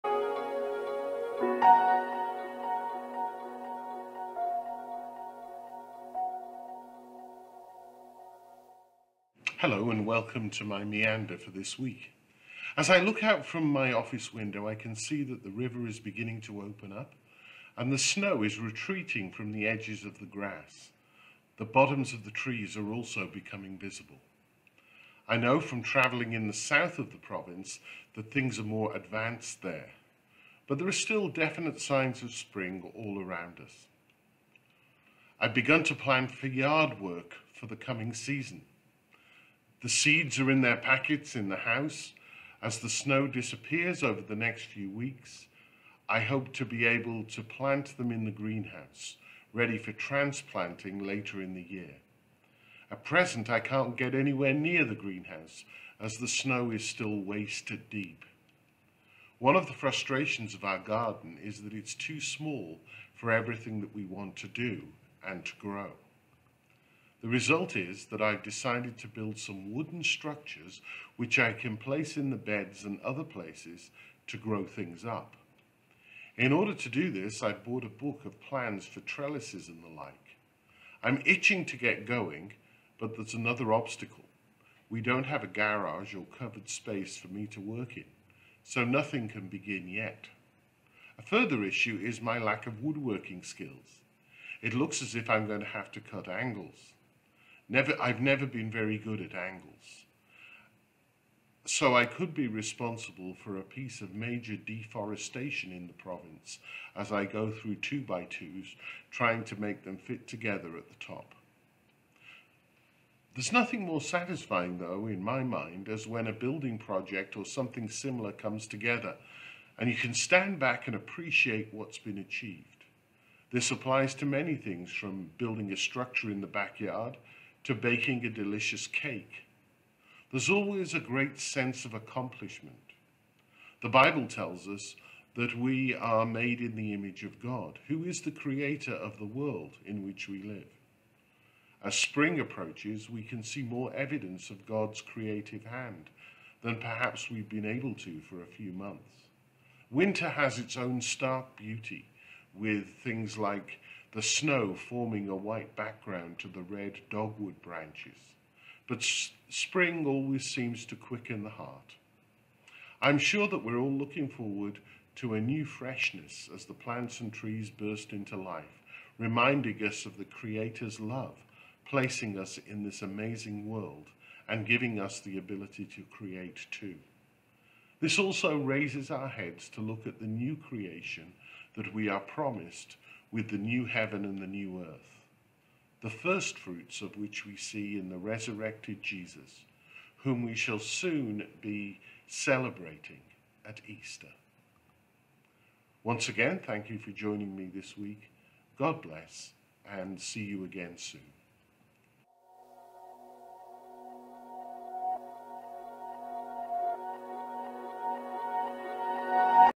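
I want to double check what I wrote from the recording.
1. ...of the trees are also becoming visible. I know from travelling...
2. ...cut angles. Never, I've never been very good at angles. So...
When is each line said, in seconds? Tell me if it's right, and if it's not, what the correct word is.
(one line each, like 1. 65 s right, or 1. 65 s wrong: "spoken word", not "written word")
1. 22 s right
2. 95 s right.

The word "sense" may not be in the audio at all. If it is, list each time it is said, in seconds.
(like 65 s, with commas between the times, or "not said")
131 s.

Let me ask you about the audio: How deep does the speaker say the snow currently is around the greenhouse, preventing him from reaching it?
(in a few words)
Waist deep.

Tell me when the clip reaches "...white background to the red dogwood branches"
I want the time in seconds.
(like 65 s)
155 s.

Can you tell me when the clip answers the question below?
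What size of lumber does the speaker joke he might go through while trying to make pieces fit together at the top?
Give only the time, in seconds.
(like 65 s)
107 s.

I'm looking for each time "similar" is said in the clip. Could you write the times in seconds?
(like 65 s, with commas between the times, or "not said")
117 s.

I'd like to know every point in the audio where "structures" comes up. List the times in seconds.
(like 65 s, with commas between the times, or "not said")
70 s, 125 s.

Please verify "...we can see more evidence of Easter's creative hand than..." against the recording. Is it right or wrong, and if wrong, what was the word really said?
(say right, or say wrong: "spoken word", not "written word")
wrong: "God", not "Easter".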